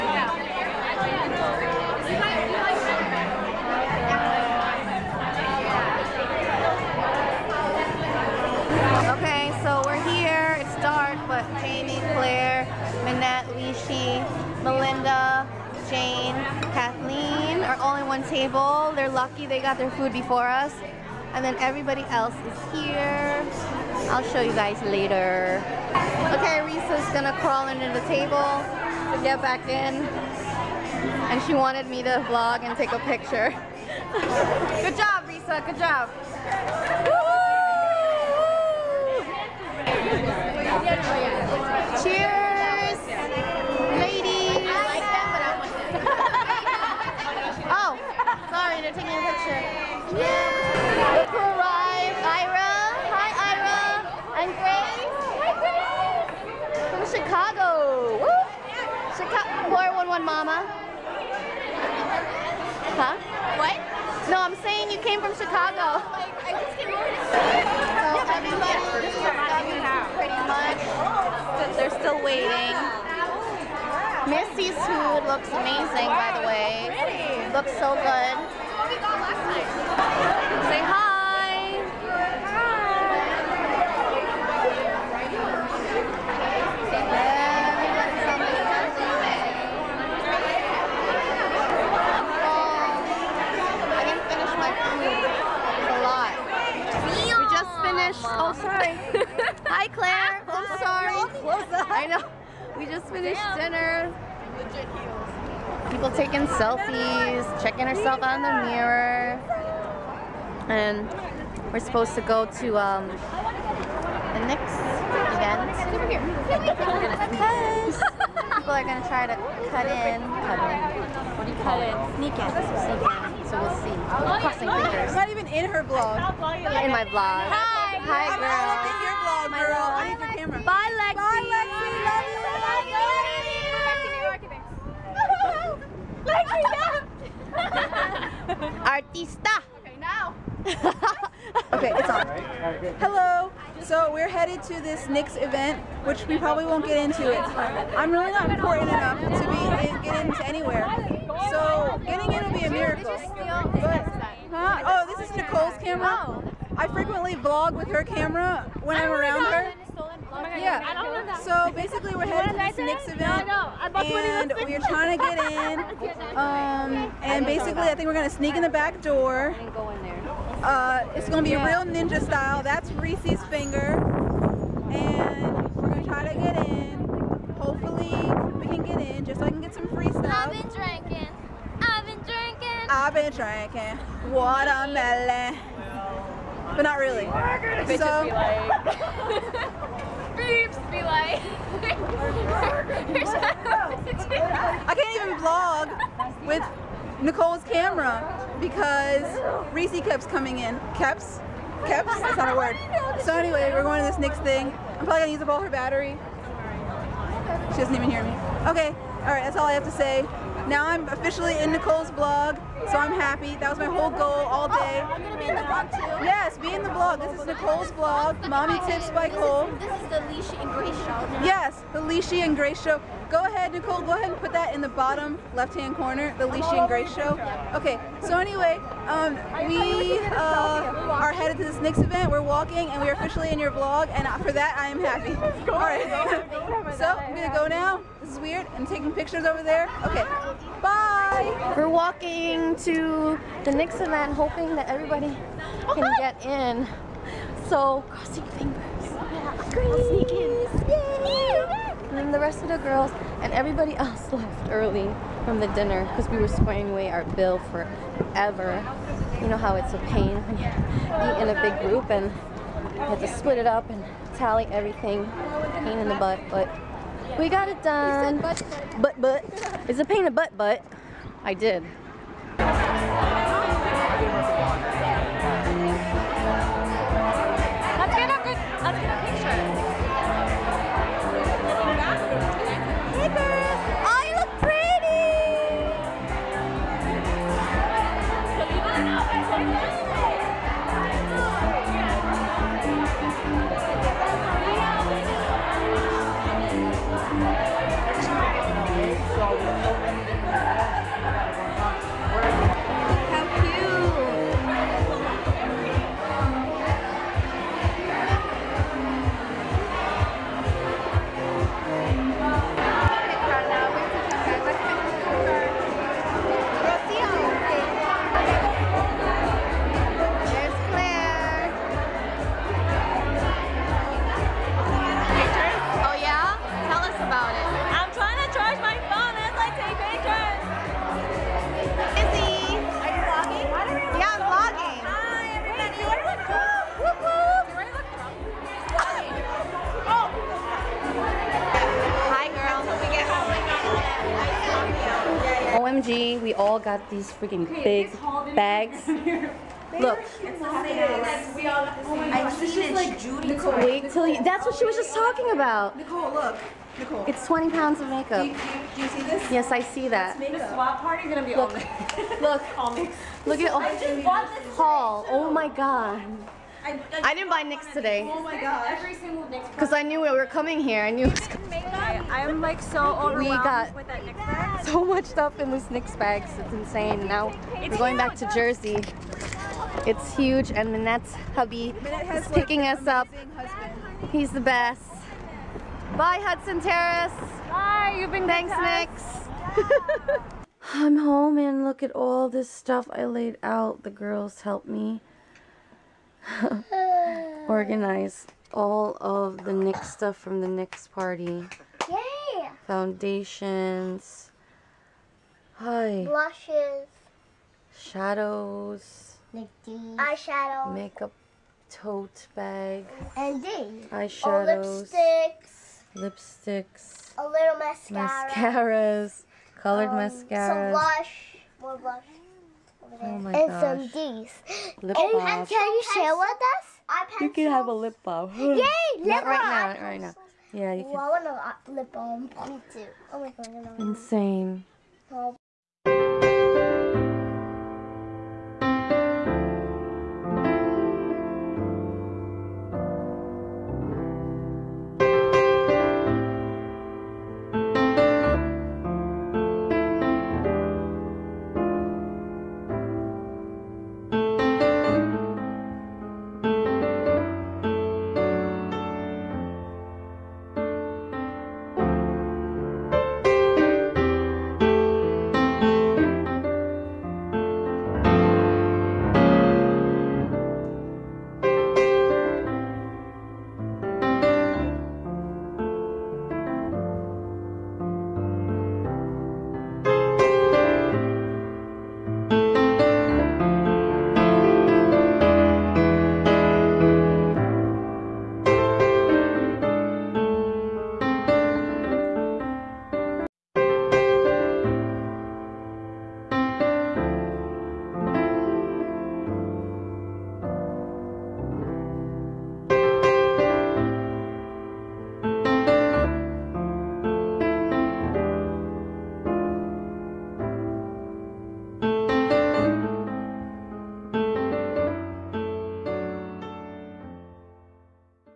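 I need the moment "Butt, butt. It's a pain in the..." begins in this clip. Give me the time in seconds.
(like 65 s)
268 s.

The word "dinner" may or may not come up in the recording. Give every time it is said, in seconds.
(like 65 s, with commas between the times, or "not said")
103 s, 255 s.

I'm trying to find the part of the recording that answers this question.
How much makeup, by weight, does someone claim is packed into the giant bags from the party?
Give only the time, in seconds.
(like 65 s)
357 s.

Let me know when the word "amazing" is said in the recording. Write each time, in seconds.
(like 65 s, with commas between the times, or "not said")
75 s.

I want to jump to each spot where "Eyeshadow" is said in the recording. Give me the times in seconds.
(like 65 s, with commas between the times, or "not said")
409 s, 414 s.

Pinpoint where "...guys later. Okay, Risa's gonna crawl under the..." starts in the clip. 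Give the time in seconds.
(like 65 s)
24 s.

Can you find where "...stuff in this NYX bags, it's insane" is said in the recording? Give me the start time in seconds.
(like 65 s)
375 s.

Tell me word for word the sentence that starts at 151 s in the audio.
So getting in will be a miracle.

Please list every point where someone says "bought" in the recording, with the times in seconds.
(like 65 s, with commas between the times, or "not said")
364 s.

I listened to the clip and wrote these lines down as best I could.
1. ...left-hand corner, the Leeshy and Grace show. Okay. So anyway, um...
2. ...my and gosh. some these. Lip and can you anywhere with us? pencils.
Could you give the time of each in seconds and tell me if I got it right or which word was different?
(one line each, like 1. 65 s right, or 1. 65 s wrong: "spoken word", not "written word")
1. 225 s right
2. 423 s wrong: "share", not "anywhere".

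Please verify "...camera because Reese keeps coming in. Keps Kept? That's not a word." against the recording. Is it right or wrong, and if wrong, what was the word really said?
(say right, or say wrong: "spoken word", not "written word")
right.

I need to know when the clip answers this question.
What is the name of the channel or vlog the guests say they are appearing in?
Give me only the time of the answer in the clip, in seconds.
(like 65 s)
218 s.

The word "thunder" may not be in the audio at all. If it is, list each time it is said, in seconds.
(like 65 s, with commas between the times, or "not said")
not said.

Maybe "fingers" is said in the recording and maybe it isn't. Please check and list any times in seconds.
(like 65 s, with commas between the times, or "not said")
124 s, 173 s, 248 s.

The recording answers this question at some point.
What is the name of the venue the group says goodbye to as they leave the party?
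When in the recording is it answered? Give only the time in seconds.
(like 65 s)
386 s.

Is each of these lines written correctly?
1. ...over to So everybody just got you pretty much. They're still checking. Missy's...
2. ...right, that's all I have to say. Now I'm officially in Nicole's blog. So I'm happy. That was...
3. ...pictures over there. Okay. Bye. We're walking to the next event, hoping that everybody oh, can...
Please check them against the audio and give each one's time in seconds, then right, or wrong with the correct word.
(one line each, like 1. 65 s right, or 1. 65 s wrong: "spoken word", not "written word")
1. 66 s wrong: "waiting", not "checking"
2. 209 s right
3. 239 s right.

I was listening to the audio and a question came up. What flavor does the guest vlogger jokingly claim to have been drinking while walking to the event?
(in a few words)
Watermelon.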